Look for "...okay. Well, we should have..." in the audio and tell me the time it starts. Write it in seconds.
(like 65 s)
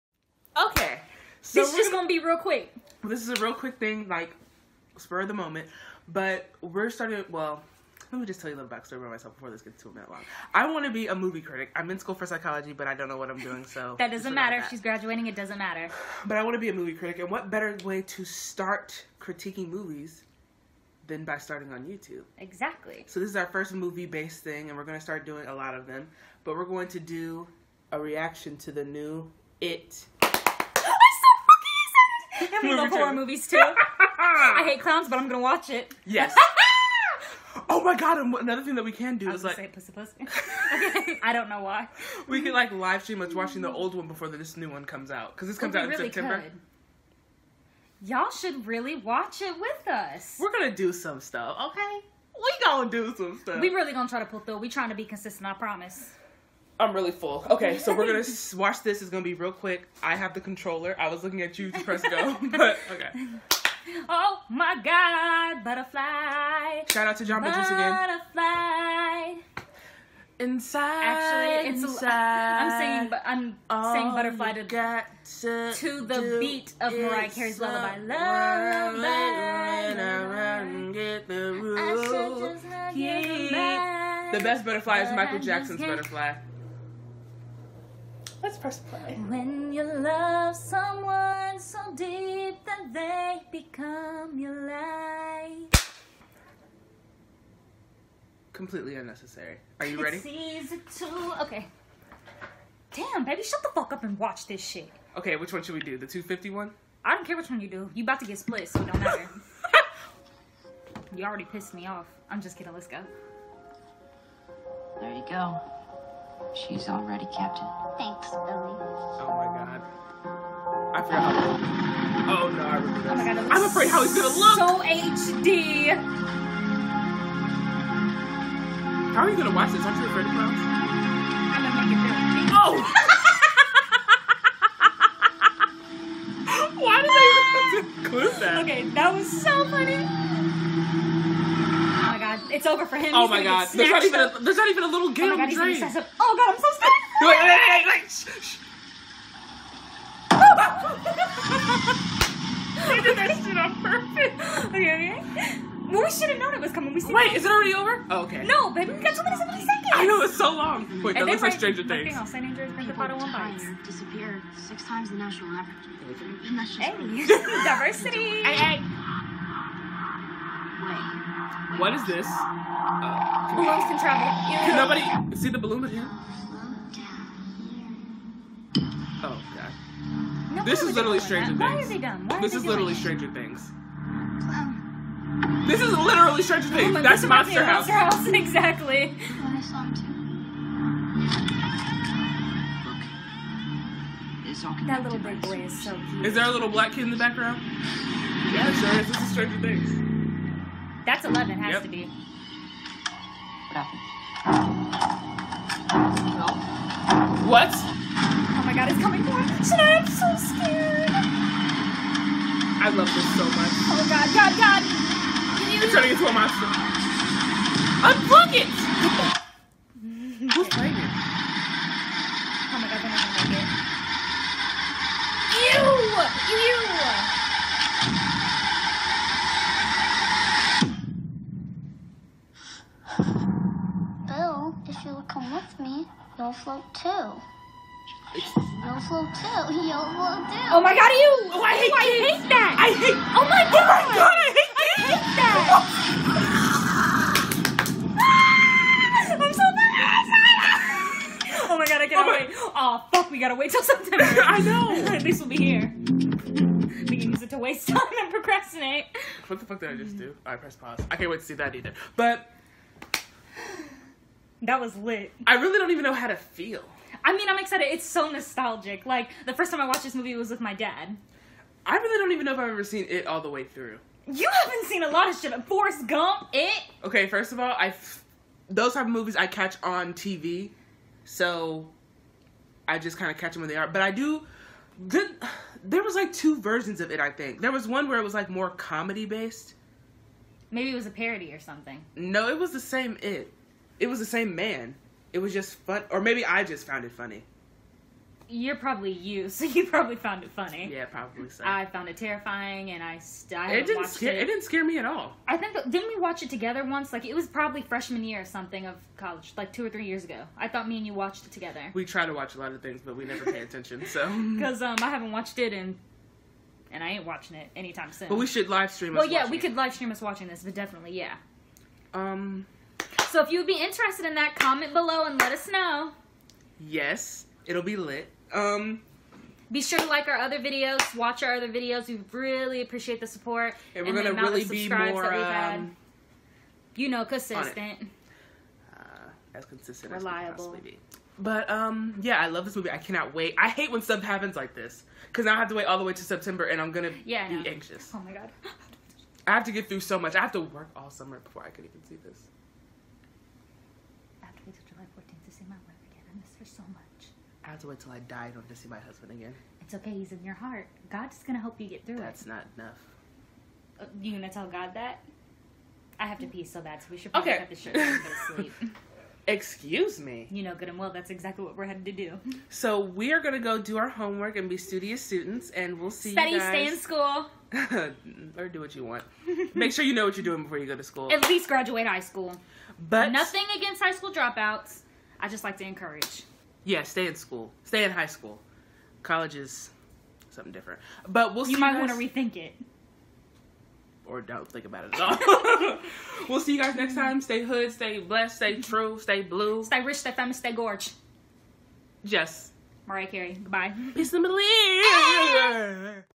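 154 s.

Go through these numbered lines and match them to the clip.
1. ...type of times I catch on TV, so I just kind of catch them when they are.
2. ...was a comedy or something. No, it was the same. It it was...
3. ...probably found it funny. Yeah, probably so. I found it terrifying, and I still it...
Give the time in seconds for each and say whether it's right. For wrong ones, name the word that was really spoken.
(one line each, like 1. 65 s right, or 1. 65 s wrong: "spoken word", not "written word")
1. 278 s wrong: "movies", not "times"
2. 290 s wrong: "parody", not "comedy"
3. 299 s right.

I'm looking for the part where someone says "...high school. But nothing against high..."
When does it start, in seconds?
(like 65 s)
382 s.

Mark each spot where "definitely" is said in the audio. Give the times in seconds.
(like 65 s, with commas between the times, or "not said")
320 s.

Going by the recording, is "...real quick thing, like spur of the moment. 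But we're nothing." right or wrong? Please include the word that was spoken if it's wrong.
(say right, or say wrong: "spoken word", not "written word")
wrong: "starting", not "nothing".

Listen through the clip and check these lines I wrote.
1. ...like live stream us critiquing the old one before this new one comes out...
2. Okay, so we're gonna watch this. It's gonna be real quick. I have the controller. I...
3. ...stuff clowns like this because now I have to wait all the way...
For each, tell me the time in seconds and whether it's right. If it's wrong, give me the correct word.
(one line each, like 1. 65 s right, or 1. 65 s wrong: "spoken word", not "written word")
1. 42 s wrong: "watching", not "critiquing"
2. 57 s right
3. 344 s wrong: "happens", not "clowns".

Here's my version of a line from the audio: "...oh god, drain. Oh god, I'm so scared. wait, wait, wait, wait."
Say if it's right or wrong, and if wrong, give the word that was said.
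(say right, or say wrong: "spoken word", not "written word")
right.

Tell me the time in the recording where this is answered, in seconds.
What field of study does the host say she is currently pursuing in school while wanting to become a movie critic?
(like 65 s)
12 s.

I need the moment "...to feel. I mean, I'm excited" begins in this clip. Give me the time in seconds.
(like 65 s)
266 s.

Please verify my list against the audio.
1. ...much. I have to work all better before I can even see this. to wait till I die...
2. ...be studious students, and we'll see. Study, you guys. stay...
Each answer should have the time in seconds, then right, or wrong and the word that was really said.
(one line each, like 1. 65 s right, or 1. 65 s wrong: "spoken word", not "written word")
1. 350 s wrong: "summer", not "better"
2. 374 s right.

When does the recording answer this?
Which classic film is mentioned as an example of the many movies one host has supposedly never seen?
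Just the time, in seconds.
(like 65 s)
275 s.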